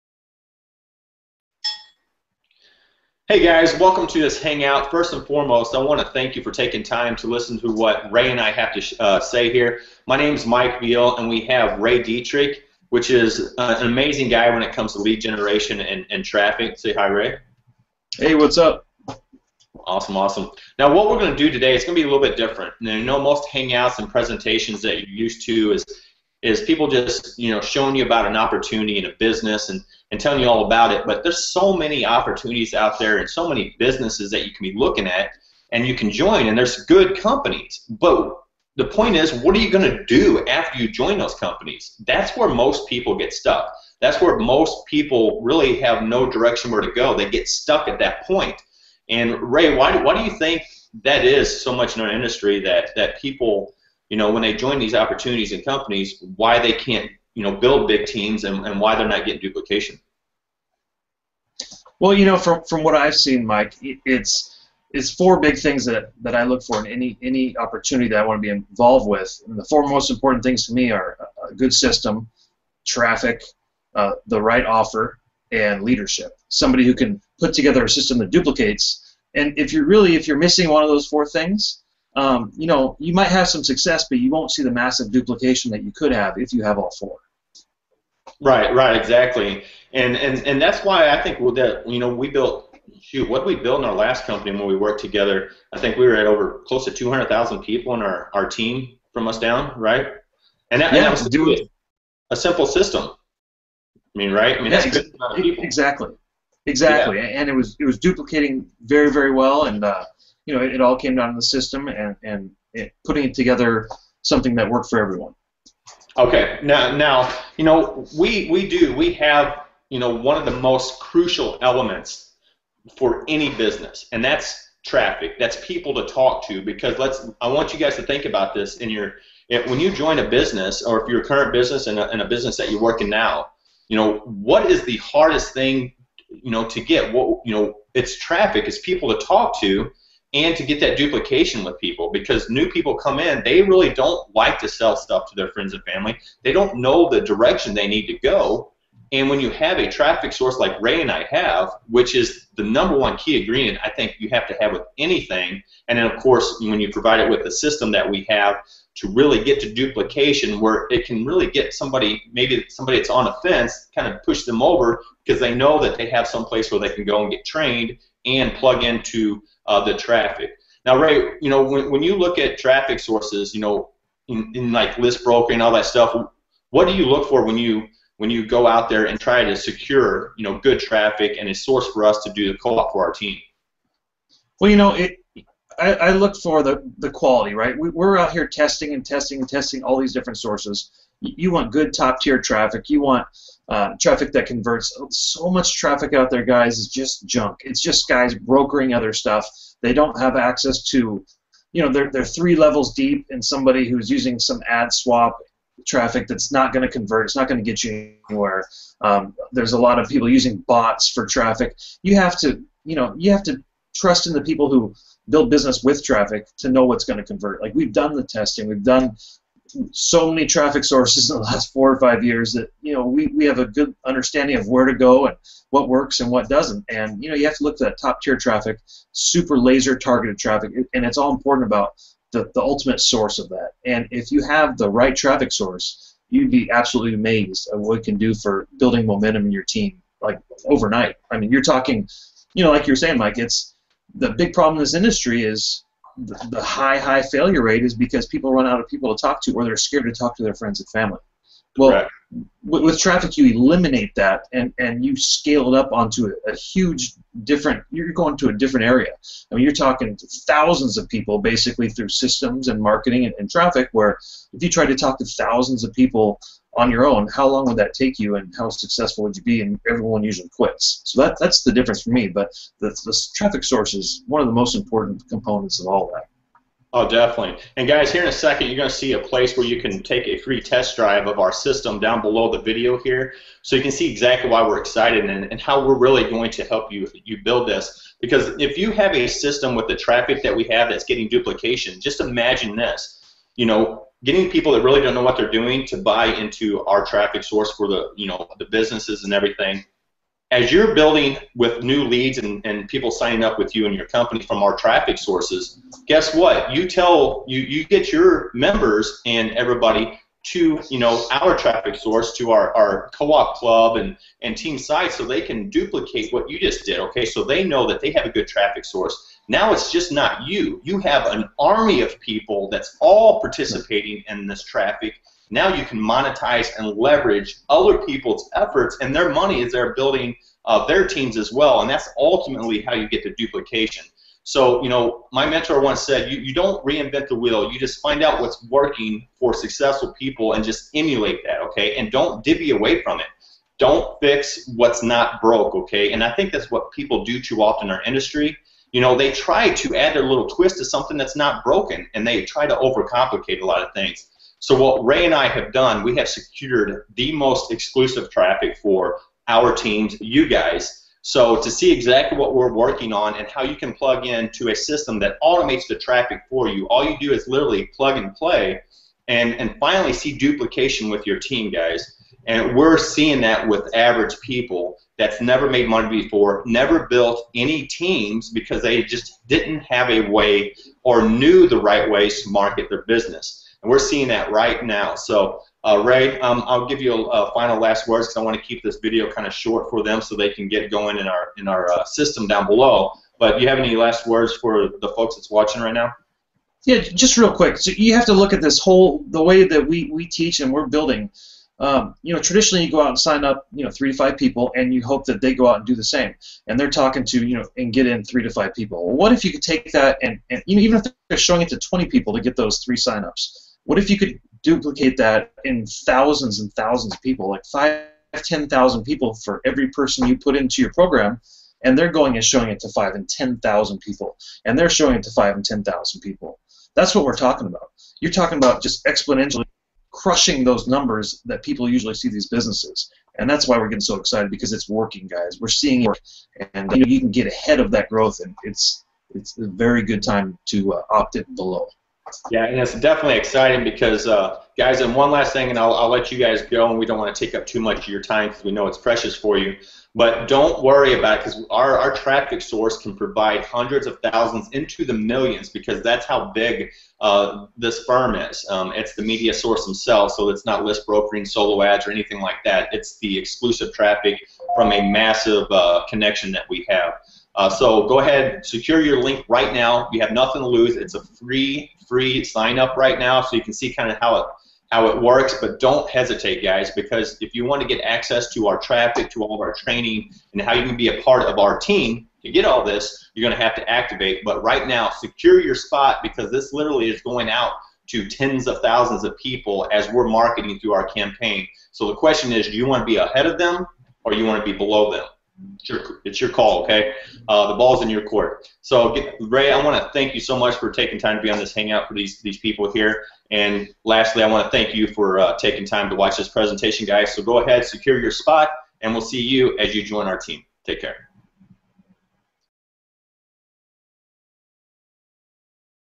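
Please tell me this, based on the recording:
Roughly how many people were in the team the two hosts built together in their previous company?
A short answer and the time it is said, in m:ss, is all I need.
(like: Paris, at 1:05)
200,000, at 1:36.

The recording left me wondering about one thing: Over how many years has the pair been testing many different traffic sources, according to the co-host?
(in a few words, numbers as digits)
4 or 5 years.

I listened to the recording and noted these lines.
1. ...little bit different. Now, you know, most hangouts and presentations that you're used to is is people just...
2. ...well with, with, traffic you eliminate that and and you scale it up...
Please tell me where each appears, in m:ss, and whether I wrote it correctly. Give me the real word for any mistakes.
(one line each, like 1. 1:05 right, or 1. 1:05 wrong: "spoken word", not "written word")
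1. 0:22 right
2. 4:11 right.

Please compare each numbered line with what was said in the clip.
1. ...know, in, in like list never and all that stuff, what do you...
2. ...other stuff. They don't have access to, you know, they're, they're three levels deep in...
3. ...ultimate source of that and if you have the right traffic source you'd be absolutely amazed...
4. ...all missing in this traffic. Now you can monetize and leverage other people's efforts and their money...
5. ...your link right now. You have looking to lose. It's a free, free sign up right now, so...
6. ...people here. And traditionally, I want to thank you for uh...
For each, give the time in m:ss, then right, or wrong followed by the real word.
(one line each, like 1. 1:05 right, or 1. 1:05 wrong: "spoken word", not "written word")
1. 2:53 wrong: "broker", not "never"
2. 3:18 right
3. 3:52 right
4. 5:23 wrong: "participating", not "missing"
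5. 7:49 wrong: "nothing", not "looking"
6. 8:22 wrong: "lastly", not "traditionally".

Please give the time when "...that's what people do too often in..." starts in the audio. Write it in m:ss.
5:46.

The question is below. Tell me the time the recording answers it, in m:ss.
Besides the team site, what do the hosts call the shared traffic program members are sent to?
5:13.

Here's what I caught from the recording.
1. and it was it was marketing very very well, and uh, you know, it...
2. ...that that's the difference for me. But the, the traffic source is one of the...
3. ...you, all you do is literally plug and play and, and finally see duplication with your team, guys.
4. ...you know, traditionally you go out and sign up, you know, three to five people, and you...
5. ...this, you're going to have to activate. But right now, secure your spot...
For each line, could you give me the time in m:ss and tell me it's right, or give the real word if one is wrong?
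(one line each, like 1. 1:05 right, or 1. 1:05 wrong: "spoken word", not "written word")
1. 1:47 wrong: "duplicating", not "marketing"
2. 4:31 right
3. 6:06 right
4. 6:42 right
5. 8:02 right.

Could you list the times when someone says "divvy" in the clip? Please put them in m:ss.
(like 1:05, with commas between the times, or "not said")
5:42.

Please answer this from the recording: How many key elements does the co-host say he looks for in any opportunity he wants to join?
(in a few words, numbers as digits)
4.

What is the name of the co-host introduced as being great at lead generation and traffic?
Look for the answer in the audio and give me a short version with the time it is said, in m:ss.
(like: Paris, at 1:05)
Ray Dietrich, at 0:11.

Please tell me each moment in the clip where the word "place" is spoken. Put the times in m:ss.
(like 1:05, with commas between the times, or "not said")
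2:46, 4:39.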